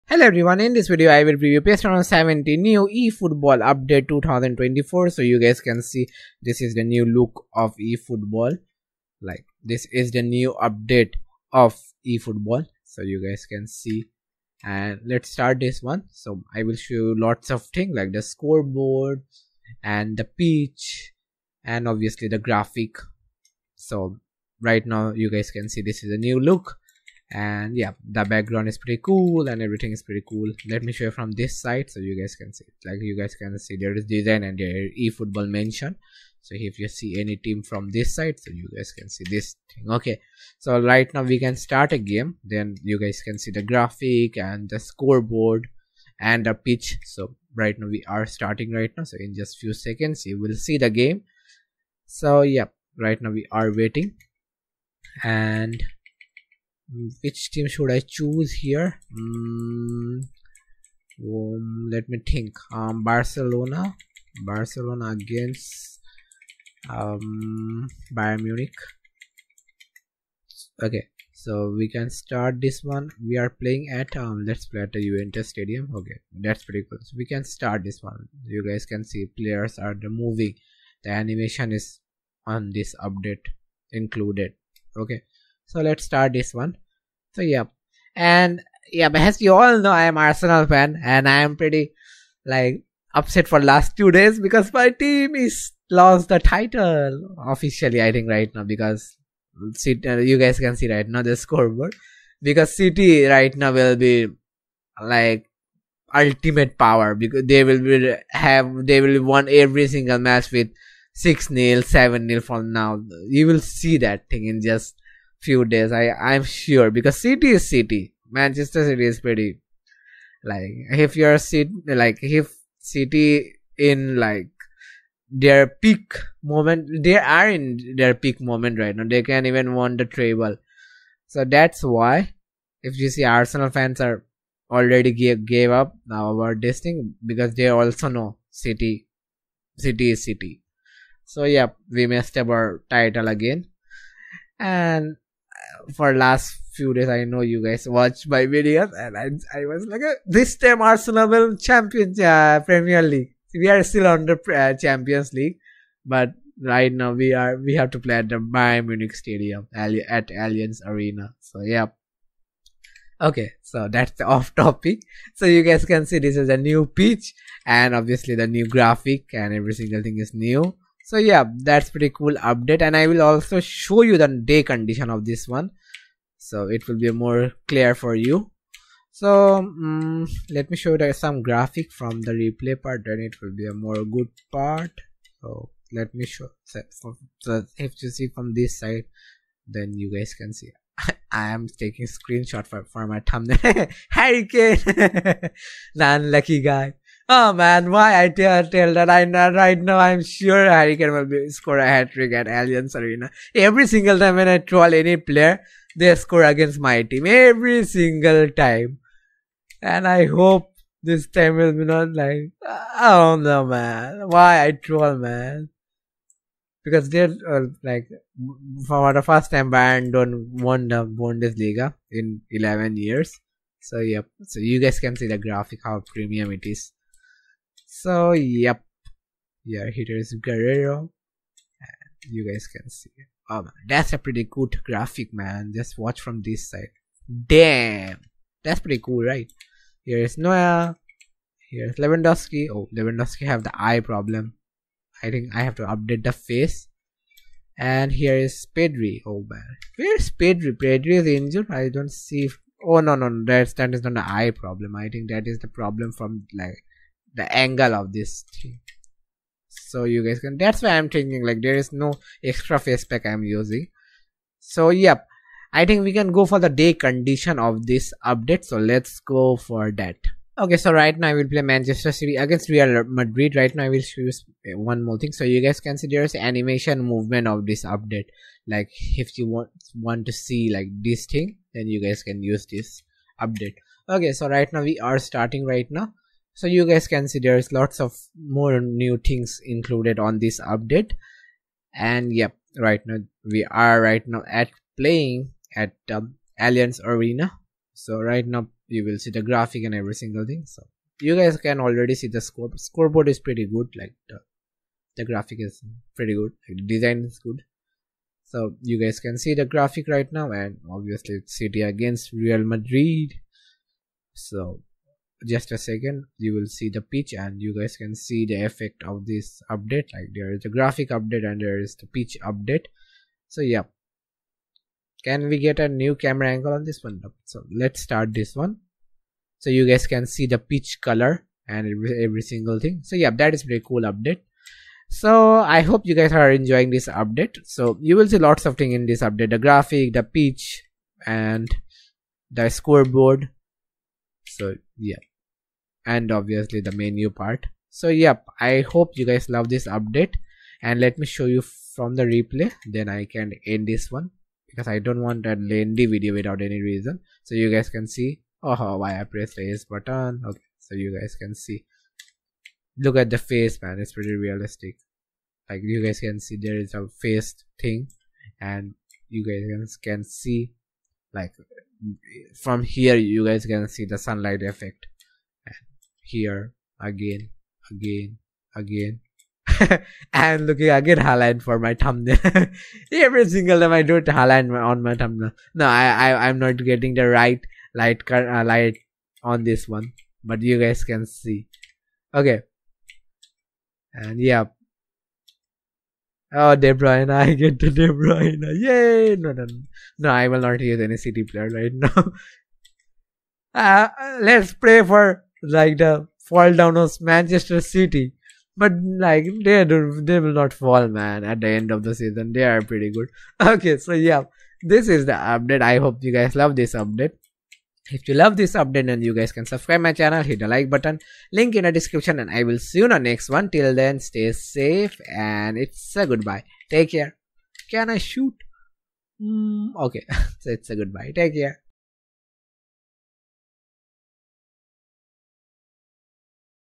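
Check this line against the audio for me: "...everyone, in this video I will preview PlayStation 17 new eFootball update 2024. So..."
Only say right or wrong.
right.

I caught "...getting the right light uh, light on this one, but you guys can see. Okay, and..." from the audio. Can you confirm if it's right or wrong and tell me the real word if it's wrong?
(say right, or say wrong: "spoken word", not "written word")
right.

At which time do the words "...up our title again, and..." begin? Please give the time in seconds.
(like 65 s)
142 s.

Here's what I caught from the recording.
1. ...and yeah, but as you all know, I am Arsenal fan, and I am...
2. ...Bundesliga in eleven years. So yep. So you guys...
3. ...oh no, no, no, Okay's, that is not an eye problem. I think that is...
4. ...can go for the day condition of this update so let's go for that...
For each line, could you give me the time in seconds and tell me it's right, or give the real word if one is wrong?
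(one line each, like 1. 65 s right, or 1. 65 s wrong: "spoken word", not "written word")
1. 88 s right
2. 221 s right
3. 252 s wrong: "That", not "Okay"
4. 266 s right.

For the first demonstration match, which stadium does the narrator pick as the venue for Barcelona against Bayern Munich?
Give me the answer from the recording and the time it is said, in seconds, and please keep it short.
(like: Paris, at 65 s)
Juventus Stadium, at 75 s.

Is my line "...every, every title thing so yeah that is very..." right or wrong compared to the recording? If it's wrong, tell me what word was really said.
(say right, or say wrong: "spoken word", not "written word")
wrong: "single", not "title".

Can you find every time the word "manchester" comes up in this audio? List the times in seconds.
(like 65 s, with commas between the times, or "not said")
118 s, 271 s, 407 s.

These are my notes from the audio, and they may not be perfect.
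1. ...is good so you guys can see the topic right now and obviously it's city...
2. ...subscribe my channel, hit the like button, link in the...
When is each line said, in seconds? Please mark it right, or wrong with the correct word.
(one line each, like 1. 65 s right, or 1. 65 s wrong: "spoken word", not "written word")
1. 307 s wrong: "graphic", not "topic"
2. 419 s right.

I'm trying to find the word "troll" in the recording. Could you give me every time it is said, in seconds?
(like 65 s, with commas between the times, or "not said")
204 s, 214 s.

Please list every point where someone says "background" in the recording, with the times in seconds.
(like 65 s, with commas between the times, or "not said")
28 s.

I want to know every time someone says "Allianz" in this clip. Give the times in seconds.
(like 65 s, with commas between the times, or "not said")
160 s, 202 s, 296 s.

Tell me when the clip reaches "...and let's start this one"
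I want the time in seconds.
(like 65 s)
14 s.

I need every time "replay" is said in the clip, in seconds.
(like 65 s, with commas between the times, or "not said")
182 s, 352 s.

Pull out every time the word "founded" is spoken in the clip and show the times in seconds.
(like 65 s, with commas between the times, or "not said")
not said.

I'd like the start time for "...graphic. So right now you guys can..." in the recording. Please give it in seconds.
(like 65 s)
22 s.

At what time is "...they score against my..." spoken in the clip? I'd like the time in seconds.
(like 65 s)
205 s.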